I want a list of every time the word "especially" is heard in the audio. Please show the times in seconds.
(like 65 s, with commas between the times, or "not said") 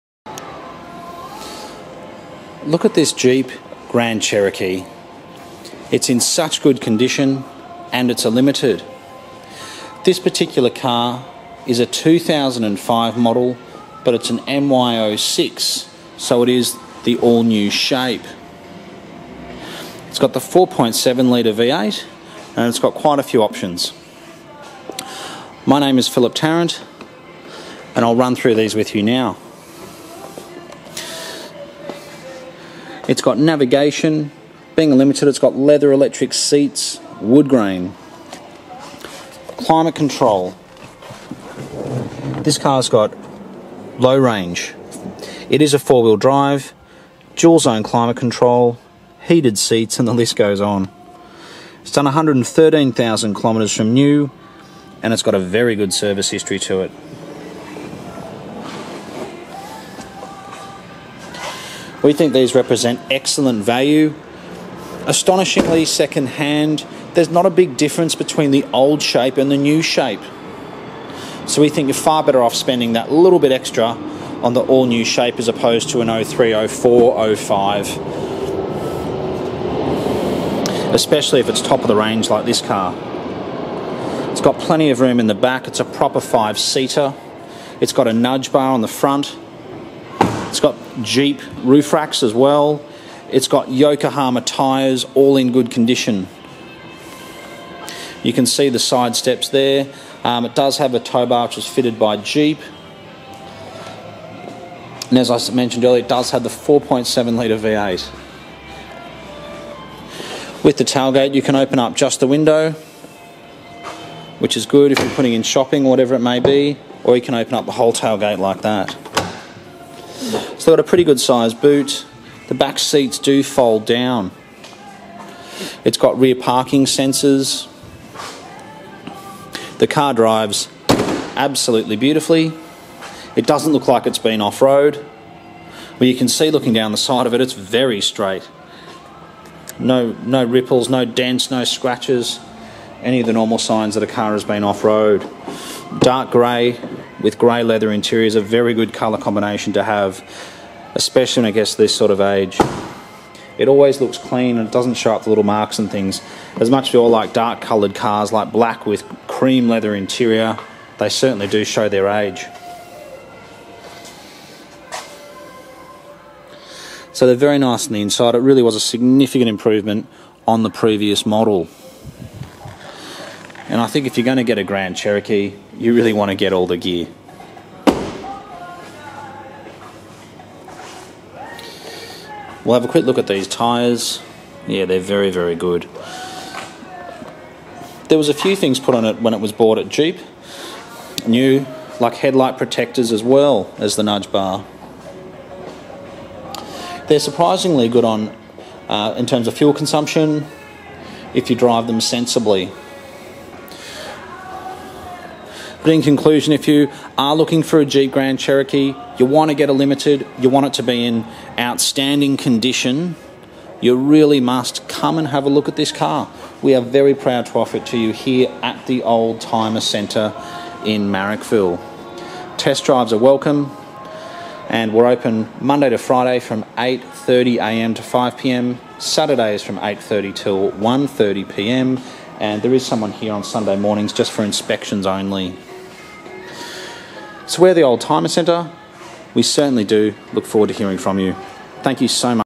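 80 s, 150 s.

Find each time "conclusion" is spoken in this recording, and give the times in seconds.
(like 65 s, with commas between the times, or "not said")
206 s.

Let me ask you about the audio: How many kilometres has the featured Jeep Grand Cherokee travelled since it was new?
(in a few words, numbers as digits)
113,000 kilometres.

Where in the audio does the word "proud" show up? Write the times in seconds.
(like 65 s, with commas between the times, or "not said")
217 s.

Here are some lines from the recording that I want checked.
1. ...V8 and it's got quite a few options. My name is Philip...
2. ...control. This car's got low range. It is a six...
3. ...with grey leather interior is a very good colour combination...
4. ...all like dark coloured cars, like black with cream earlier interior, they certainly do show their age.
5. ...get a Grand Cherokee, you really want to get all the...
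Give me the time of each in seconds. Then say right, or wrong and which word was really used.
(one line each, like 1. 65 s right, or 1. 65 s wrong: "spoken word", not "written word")
1. 21 s right
2. 39 s wrong: "four", not "six"
3. 147 s right
4. 156 s wrong: "leather", not "earlier"
5. 174 s right.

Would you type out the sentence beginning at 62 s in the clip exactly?
We think these represent excellent value.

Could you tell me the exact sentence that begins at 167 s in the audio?
So they're very nice on the inside.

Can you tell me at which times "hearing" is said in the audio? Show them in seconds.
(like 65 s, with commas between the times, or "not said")
240 s.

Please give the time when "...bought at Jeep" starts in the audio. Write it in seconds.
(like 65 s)
189 s.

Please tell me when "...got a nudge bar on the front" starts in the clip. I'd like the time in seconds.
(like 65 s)
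87 s.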